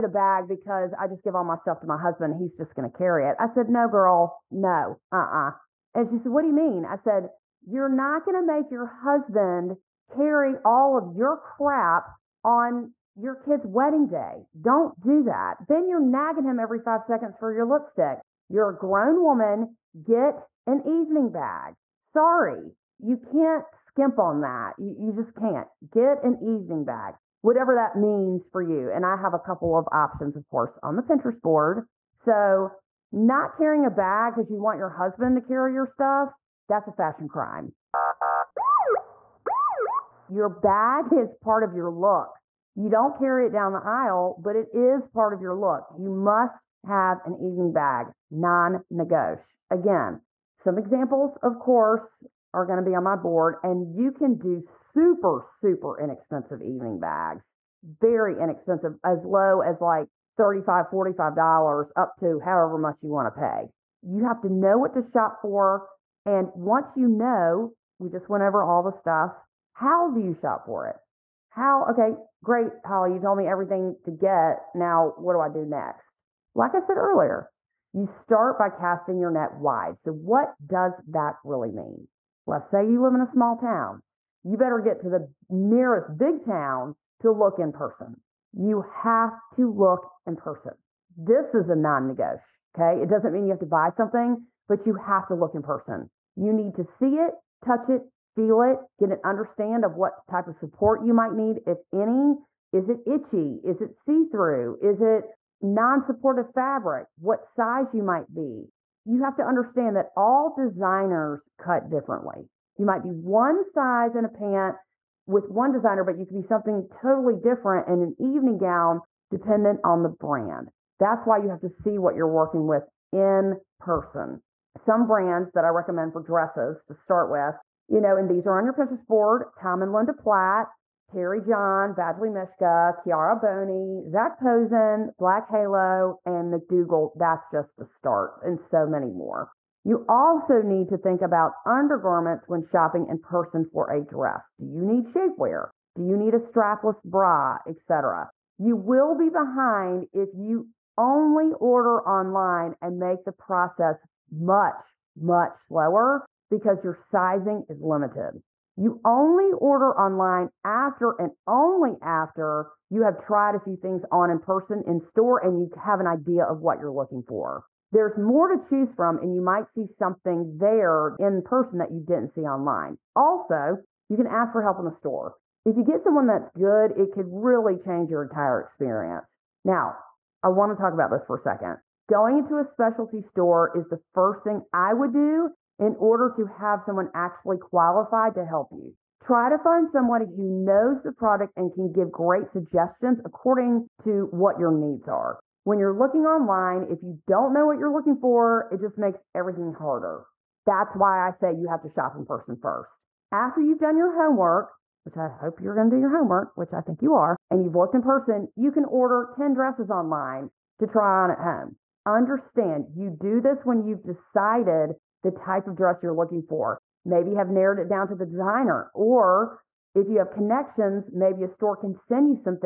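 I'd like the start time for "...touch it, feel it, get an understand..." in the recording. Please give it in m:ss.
1:37.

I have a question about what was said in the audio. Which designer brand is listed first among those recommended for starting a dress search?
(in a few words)
Tom and Linda Platt.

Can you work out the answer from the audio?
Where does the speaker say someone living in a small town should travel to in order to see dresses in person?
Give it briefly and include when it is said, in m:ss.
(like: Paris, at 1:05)
nearest big town, at 1:25.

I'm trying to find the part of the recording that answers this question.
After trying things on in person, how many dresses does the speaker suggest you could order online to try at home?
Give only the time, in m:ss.
3:29.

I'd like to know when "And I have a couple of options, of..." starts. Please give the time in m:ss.
0:28.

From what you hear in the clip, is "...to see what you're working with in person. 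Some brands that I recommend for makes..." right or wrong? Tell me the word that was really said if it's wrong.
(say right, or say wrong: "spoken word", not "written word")
wrong: "dresses", not "makes".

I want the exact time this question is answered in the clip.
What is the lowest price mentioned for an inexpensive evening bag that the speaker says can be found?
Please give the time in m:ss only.
1:00.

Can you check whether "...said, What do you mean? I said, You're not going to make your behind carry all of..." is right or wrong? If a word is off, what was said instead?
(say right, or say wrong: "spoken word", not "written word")
wrong: "husband", not "behind".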